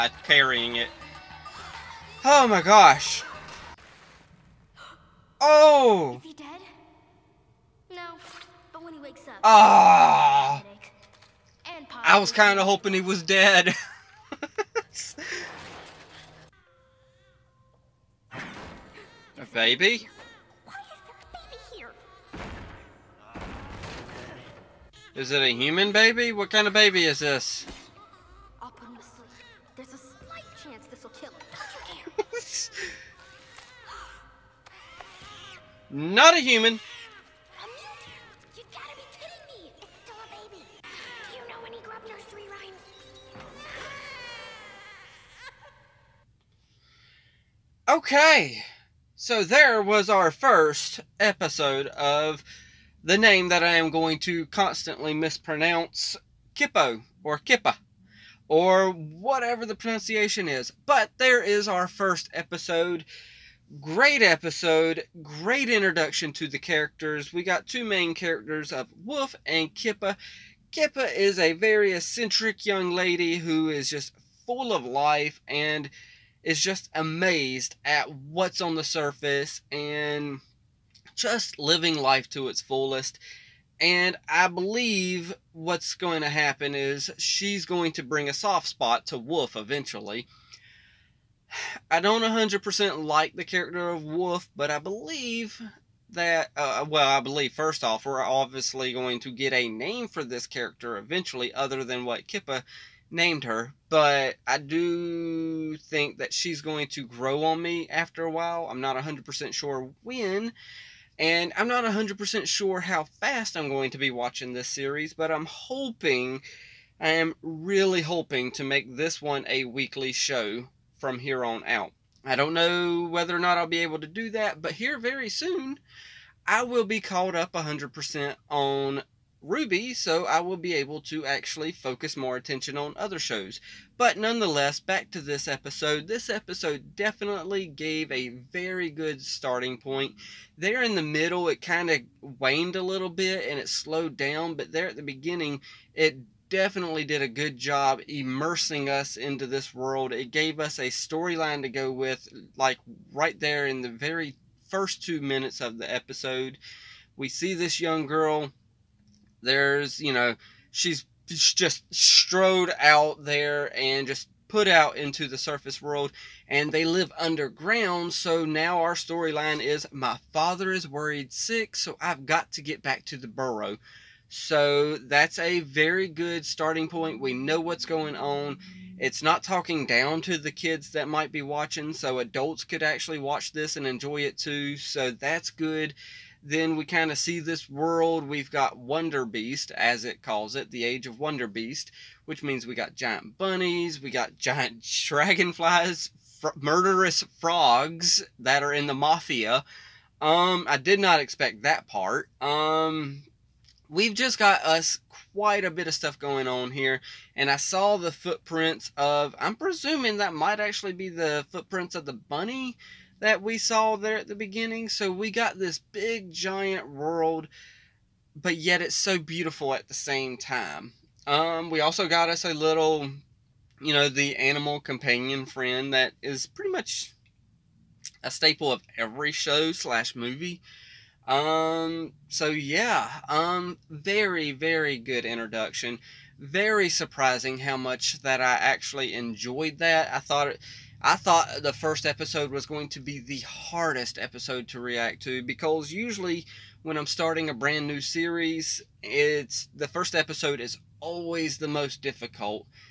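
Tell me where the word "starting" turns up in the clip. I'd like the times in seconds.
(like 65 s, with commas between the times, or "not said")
139 s, 176 s, 247 s.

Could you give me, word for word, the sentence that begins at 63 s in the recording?
Great episode, great introduction to the characters.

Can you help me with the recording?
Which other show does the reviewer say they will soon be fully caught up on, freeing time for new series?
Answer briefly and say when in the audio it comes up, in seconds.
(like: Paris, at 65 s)
RWBY, at 129 s.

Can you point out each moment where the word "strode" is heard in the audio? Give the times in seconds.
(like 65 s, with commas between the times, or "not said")
161 s.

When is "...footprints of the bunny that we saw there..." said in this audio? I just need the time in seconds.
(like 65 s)
211 s.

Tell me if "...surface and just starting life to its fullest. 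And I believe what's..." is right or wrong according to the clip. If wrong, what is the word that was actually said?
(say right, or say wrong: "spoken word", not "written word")
wrong: "living", not "starting".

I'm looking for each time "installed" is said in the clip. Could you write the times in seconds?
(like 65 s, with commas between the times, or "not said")
not said.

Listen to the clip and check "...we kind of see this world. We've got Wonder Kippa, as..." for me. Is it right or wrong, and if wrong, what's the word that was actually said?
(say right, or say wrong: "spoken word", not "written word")
wrong: "Beast", not "Kippa".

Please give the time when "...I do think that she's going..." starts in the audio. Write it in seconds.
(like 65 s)
104 s.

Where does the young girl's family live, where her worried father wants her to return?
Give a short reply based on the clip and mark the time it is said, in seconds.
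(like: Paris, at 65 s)
the burrow, at 173 s.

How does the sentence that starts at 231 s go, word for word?
Um, so yeah, um, very, very good introduction.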